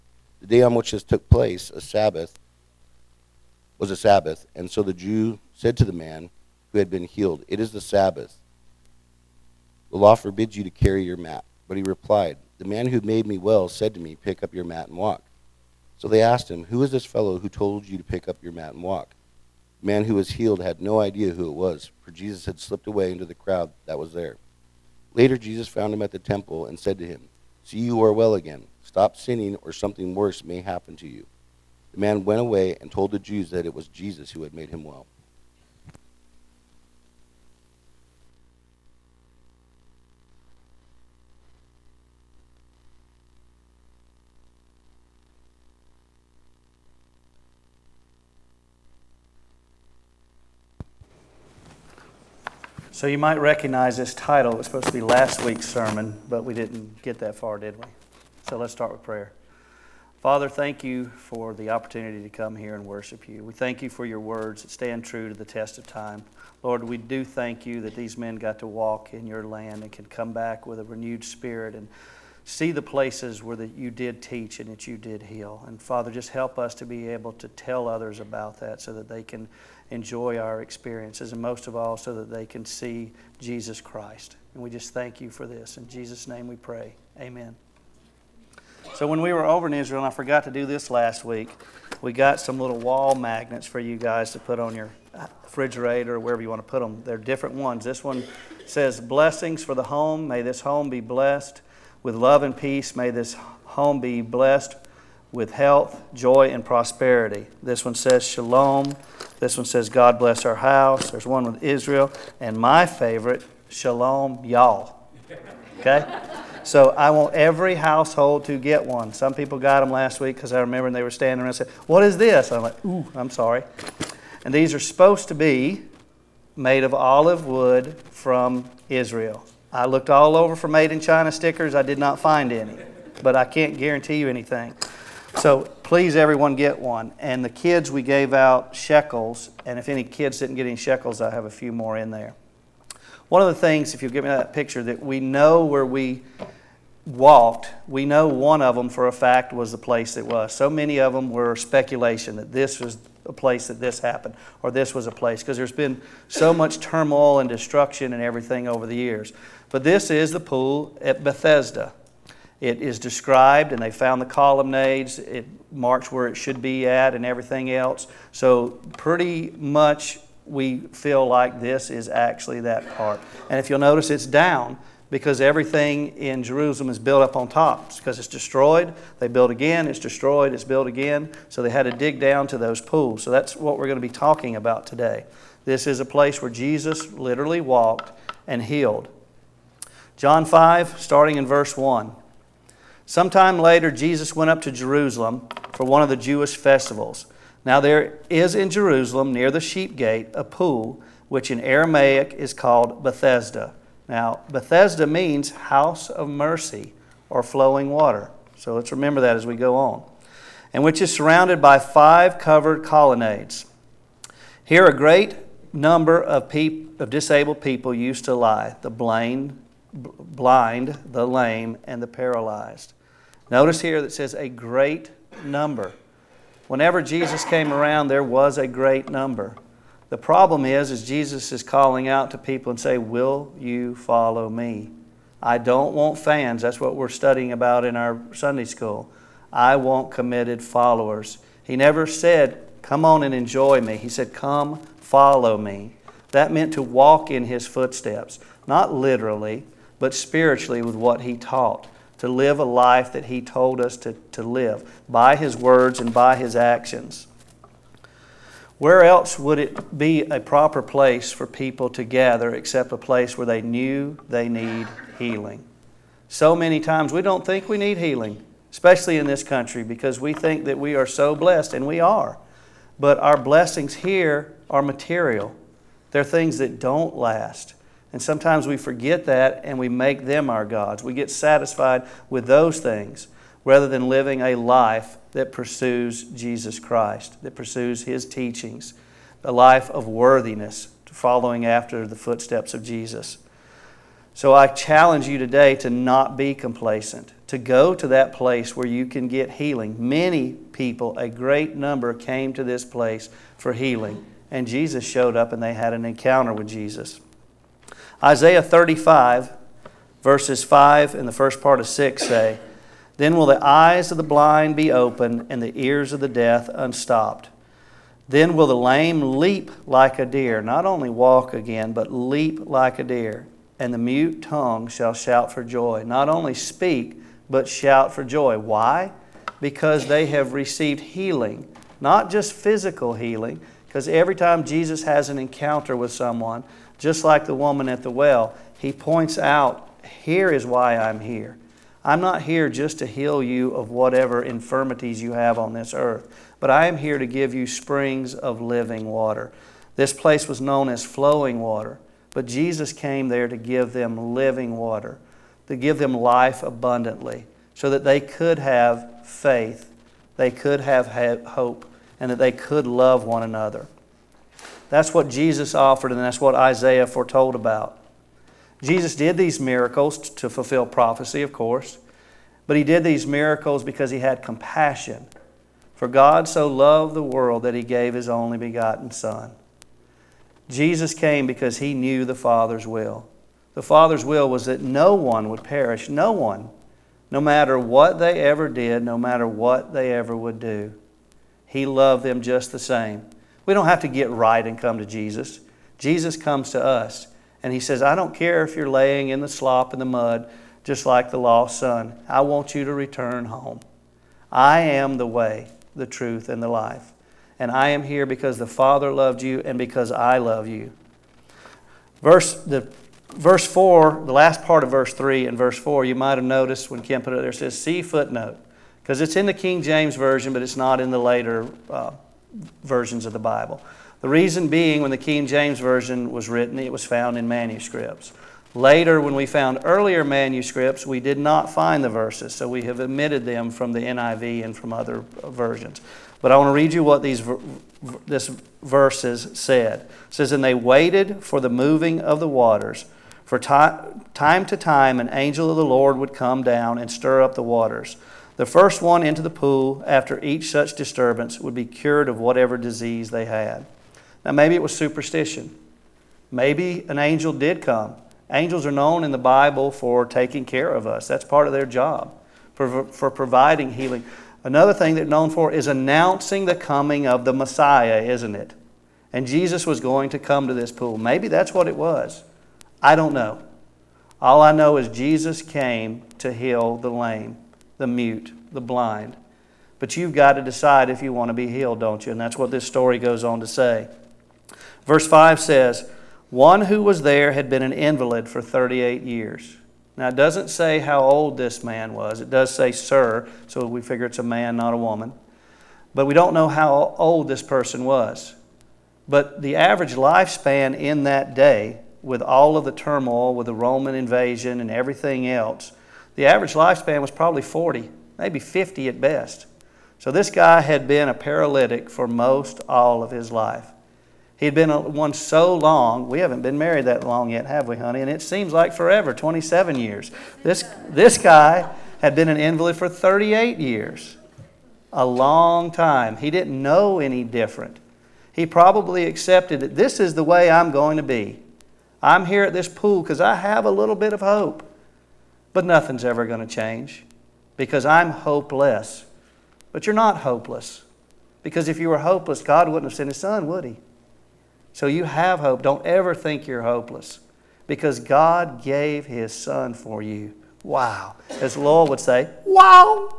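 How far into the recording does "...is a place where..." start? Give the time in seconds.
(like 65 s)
185 s.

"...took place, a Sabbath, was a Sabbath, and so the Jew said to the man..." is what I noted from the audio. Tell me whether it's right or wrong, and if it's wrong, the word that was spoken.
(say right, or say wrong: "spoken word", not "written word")
right.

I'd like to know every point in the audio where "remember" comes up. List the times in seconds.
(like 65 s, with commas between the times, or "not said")
120 s, 208 s.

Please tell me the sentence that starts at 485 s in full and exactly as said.
Verse 5 says, One who was there had been an invalid for 38 years.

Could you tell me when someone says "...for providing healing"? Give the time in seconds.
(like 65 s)
463 s.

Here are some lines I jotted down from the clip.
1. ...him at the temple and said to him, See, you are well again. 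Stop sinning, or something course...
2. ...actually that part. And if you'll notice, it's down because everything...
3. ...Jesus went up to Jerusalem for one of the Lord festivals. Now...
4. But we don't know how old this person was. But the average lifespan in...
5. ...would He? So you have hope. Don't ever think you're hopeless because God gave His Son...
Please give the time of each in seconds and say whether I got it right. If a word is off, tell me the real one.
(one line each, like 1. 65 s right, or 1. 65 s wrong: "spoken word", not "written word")
1. 25 s wrong: "worse", not "course"
2. 172 s right
3. 193 s wrong: "Jewish", not "Lord"
4. 496 s right
5. 543 s right.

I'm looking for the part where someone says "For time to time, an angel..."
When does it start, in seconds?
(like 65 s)
443 s.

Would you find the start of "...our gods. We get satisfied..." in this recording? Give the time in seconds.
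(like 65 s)
280 s.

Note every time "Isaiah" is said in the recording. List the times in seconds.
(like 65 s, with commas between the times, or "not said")
308 s, 366 s.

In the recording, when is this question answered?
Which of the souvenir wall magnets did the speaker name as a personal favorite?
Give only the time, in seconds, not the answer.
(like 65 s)
113 s.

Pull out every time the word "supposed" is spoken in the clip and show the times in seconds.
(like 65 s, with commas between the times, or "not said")
54 s, 124 s.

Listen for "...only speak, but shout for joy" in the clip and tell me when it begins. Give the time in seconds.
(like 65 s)
326 s.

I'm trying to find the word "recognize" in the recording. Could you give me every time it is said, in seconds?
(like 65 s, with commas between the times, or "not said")
53 s.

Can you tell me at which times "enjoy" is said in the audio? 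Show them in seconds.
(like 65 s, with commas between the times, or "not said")
79 s, 243 s.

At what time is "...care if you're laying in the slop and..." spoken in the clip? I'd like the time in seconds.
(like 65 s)
398 s.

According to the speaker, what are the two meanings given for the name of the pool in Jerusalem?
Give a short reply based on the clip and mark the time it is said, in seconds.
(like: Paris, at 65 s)
House of mercy or flowing water, at 205 s.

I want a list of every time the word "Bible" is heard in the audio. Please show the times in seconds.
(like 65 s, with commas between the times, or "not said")
423 s, 459 s.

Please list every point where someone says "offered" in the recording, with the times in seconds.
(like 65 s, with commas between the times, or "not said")
365 s.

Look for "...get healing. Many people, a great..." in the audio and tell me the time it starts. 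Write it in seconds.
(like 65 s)
299 s.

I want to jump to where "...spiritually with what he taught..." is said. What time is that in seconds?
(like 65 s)
250 s.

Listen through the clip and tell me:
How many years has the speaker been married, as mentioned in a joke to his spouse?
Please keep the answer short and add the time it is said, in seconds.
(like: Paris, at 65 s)
27, at 519 s.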